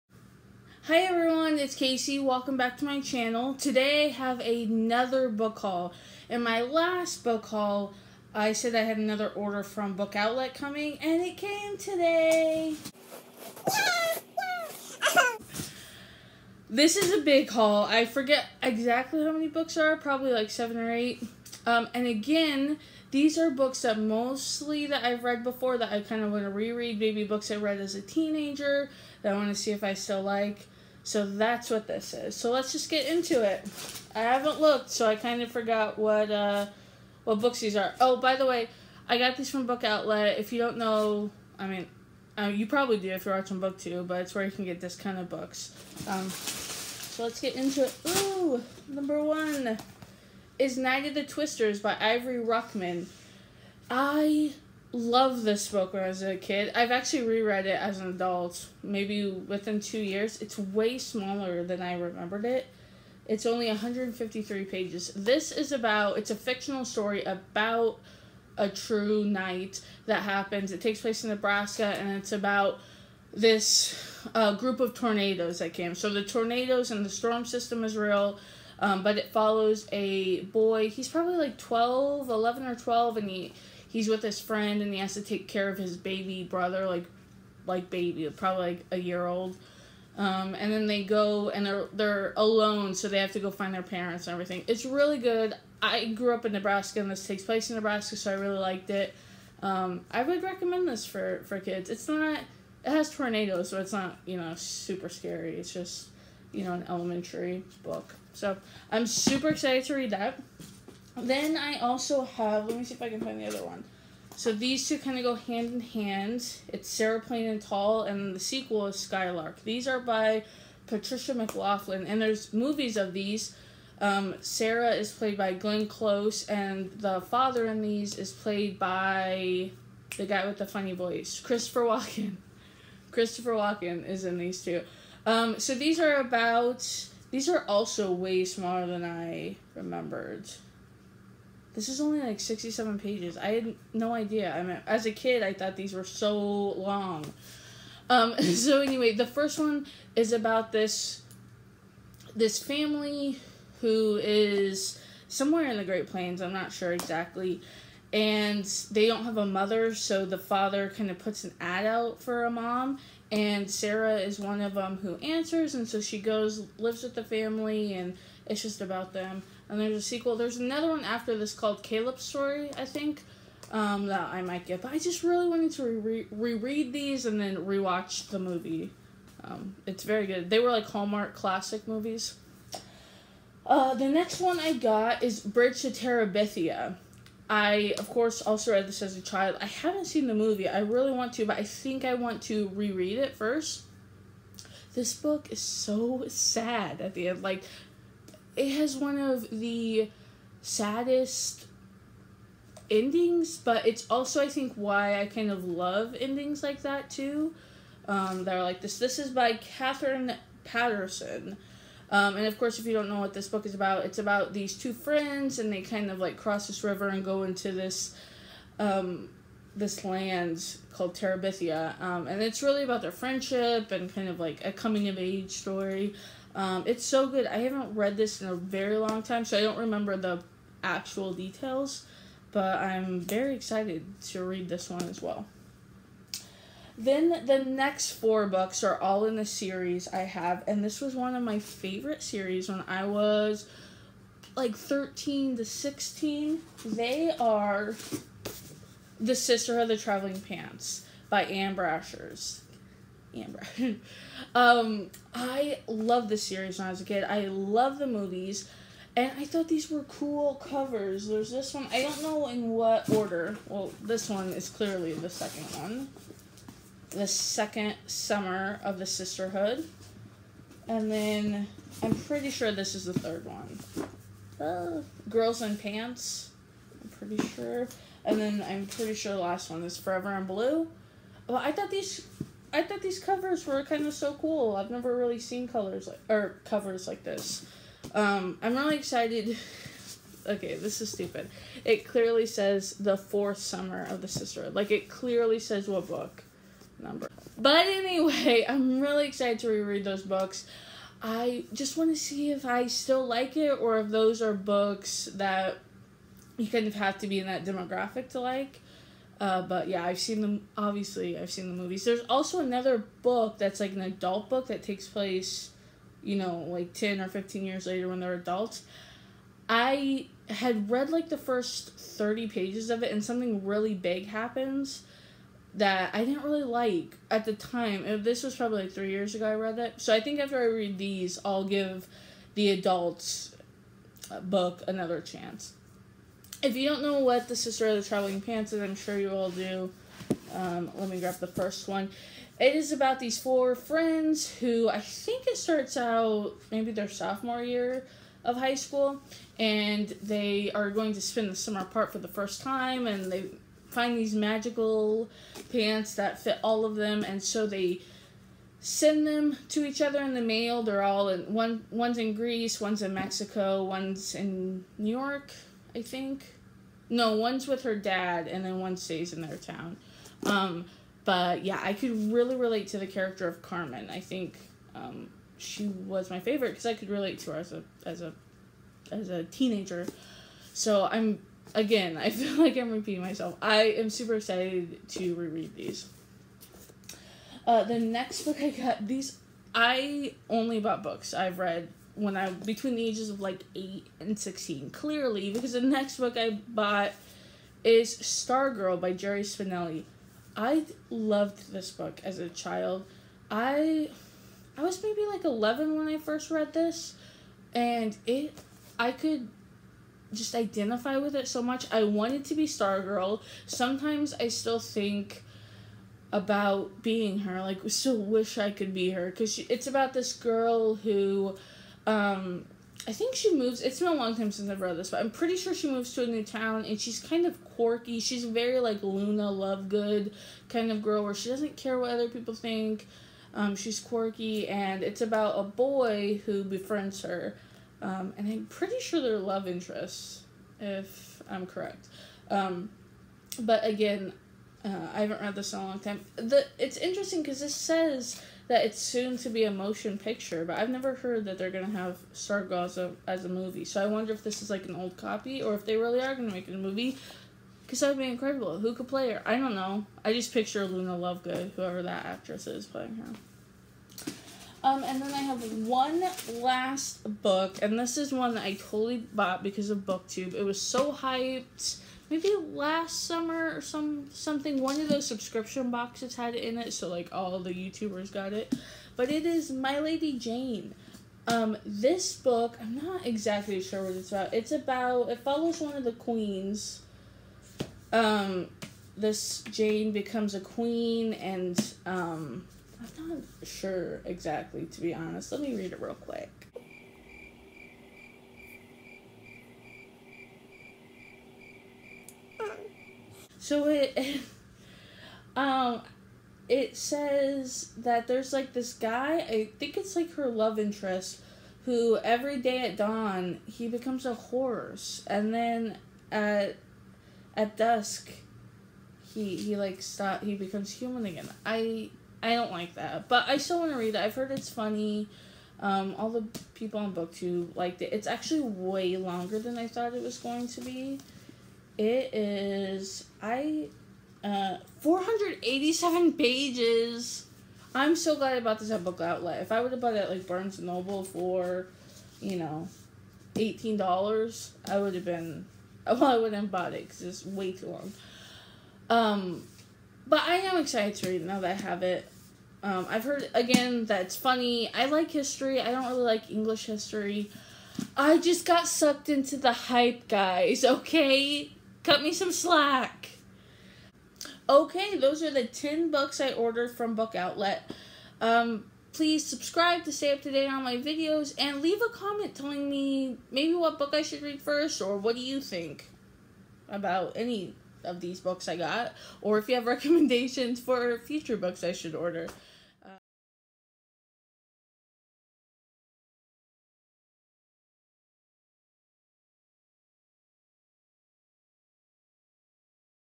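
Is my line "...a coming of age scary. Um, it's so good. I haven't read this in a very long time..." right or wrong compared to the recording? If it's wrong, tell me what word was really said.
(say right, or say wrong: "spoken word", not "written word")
wrong: "story", not "scary".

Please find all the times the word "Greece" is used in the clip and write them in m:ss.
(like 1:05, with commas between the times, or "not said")
6:02.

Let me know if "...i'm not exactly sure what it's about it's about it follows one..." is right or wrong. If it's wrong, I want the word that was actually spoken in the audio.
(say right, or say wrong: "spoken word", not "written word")
right.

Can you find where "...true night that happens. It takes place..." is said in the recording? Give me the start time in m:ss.
1:08.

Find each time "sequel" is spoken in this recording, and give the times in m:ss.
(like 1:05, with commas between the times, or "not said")
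1:58, 2:50.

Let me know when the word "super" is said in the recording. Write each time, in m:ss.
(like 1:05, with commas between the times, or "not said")
1:44, 1:49, 6:24.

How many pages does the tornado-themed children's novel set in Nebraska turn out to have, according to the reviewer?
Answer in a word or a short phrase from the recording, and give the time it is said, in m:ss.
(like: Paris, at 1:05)
153, at 1:03.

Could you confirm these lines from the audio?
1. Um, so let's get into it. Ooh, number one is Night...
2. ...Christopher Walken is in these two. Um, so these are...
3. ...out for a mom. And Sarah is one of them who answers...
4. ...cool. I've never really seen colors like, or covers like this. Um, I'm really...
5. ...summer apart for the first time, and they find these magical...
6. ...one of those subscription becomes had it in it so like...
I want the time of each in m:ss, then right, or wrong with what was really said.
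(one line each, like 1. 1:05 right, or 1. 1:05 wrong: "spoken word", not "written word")
1. 0:46 right
2. 2:13 right
3. 2:41 right
4. 4:44 right
5. 5:51 right
6. 7:54 wrong: "boxes", not "becomes".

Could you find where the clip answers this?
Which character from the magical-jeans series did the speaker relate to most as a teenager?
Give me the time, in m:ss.
6:13.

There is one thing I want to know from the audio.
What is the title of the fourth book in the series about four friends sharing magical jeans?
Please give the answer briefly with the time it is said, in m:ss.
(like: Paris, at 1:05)
Forever in Blue, at 4:39.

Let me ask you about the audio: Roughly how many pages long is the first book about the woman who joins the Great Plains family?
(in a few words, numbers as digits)
67.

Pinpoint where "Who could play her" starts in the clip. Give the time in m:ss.
7:38.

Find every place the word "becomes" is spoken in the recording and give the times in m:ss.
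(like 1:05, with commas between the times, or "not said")
8:10, 8:33, 8:40.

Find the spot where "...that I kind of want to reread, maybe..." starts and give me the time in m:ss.
0:25.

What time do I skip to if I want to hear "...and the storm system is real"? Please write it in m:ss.
1:16.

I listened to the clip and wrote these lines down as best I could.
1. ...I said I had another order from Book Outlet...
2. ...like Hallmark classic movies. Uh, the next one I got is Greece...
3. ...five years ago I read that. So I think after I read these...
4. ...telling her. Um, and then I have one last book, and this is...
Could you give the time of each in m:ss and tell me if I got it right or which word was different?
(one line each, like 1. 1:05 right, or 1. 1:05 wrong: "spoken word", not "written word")
1. 0:08 right
2. 3:00 wrong: "Bridge", not "Greece"
3. 5:28 wrong: "three", not "five"
4. 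7:42 wrong: "playing", not "telling".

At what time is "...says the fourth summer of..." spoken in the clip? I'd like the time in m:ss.
4:52.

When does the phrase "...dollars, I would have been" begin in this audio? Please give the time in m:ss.
9:03.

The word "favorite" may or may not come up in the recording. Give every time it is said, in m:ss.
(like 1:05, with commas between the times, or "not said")
4:01, 6:16.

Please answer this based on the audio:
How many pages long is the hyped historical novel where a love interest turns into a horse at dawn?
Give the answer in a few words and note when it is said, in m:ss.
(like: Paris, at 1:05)
487, at 8:55.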